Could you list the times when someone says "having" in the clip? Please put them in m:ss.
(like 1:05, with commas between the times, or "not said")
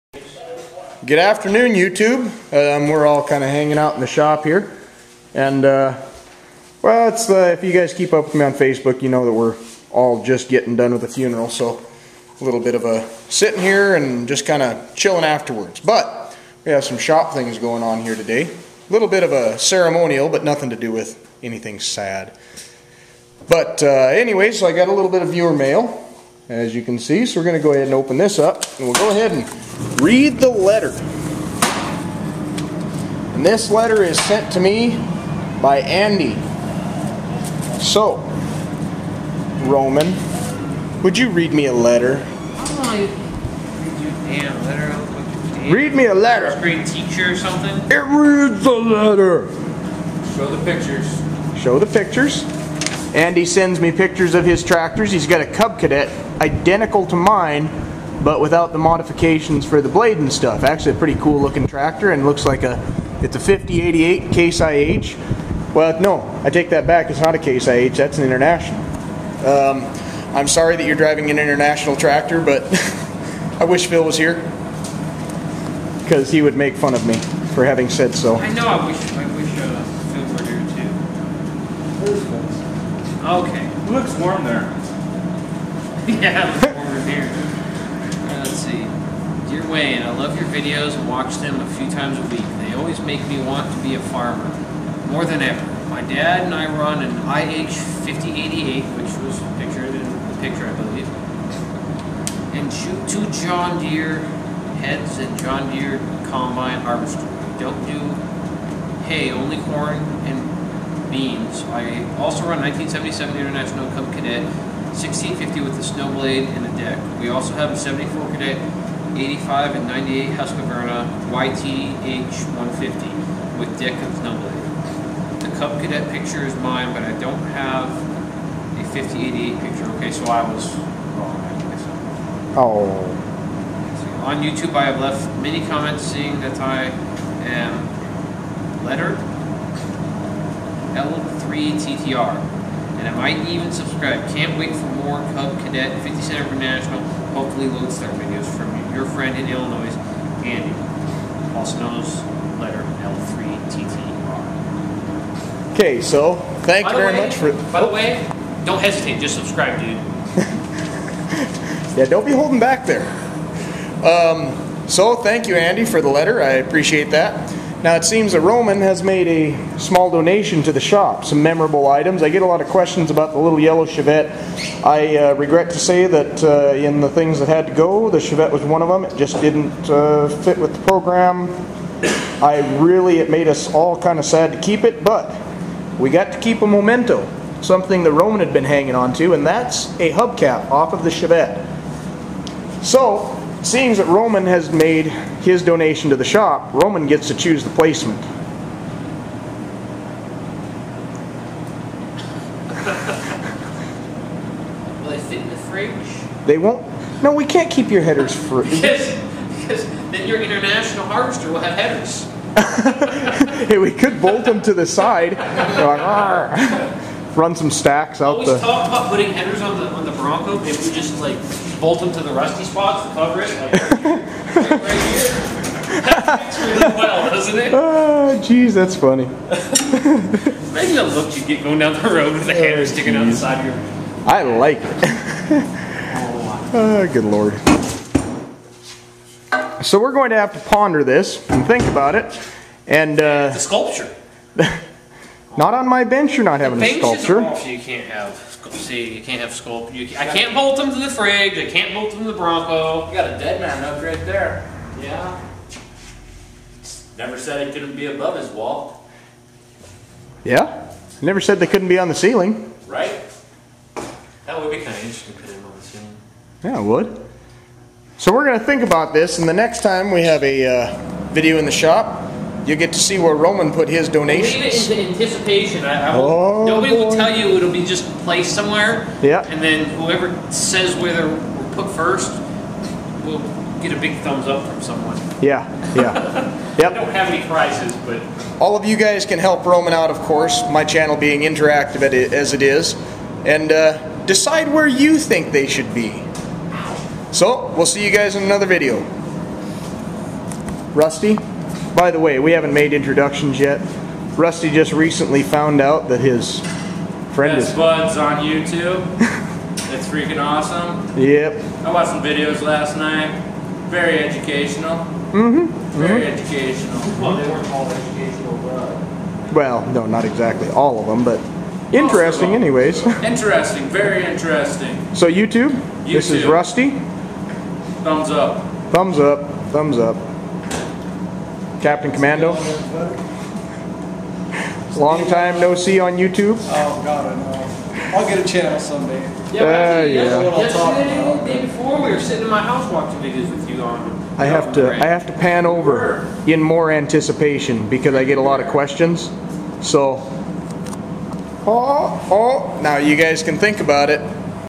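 1:17, 4:06.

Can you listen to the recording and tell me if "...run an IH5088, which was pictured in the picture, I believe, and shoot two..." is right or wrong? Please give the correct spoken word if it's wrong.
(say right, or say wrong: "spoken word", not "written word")
right.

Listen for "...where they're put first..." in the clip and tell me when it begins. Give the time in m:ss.
4:40.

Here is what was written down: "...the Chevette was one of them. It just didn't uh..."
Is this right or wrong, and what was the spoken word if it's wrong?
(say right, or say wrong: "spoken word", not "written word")
right.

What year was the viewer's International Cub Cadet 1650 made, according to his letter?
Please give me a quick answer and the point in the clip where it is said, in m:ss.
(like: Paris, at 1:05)
1977, at 1:52.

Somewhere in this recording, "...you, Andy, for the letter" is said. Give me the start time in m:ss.
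2:45.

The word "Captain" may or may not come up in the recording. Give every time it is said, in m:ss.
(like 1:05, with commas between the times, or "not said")
5:31.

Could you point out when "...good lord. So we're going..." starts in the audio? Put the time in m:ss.
3:57.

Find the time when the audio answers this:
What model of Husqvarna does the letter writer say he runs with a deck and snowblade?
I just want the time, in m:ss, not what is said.
2:01.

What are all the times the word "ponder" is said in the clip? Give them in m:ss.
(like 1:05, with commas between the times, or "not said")
4:00.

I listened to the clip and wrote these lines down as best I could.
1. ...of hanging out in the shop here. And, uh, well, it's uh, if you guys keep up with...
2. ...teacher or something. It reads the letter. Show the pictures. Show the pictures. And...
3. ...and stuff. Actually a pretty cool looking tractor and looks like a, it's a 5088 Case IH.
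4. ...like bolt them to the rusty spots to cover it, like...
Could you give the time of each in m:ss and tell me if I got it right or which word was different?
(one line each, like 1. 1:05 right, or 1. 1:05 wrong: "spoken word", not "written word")
1. 0:03 right
2. 0:46 right
3. 1:00 right
4. 3:41 right.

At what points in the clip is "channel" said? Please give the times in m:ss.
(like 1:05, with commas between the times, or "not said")
4:50, 5:38.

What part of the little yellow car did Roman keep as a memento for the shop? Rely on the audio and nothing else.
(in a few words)
hubcap.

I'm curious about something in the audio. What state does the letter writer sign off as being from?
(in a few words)
Illinois.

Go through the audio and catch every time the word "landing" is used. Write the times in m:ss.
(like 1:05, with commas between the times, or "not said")
not said.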